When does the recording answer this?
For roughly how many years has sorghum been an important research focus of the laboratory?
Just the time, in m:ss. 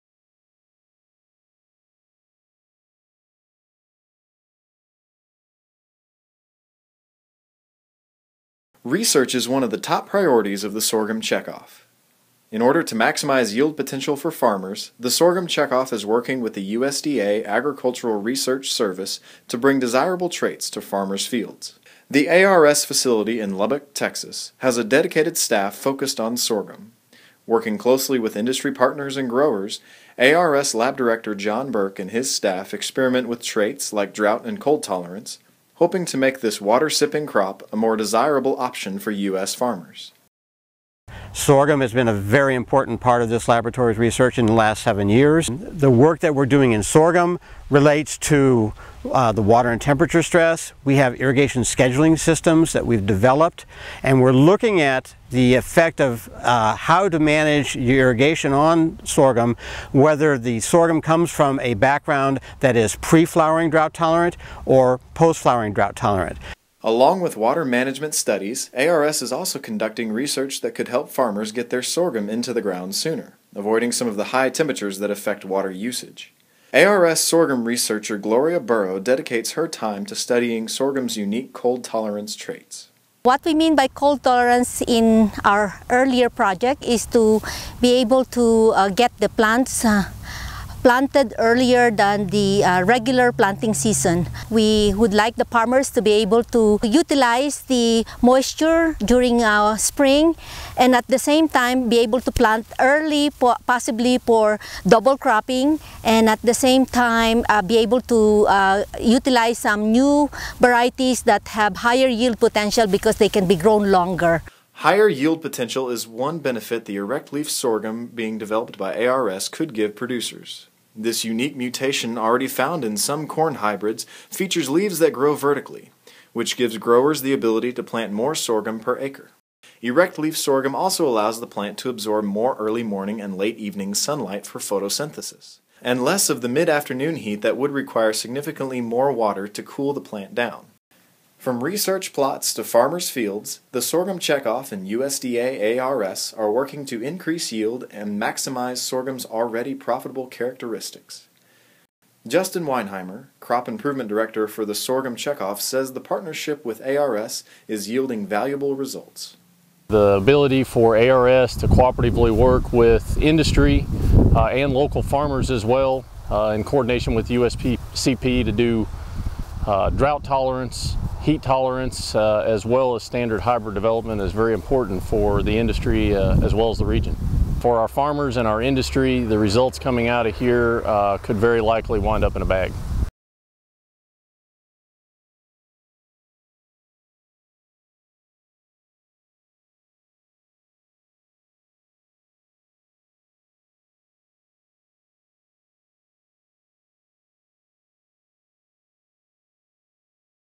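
0:44.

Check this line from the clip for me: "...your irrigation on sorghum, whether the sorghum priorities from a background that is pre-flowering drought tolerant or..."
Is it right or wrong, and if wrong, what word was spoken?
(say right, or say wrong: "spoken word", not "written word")
wrong: "comes", not "priorities".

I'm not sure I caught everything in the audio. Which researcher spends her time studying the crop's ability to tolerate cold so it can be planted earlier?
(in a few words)
Gloria Burow.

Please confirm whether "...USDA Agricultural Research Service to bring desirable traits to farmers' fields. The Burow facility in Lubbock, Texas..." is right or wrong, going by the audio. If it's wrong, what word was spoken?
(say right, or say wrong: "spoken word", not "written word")
wrong: "ARS", not "Burow".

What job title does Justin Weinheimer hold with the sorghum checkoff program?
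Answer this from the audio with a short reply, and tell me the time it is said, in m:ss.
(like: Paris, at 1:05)
Crop Improvement Director, at 2:33.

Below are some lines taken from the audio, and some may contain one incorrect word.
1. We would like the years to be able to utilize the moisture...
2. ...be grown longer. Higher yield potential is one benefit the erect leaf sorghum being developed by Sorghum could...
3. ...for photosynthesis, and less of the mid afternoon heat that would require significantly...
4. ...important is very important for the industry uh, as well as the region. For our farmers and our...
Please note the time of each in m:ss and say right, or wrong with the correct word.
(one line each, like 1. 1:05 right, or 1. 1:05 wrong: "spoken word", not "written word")
1. 1:34 wrong: "farmers", not "years"
2. 1:53 wrong: "ARS", not "Sorghum"
3. 2:14 right
4. 2:53 wrong: "development", not "important".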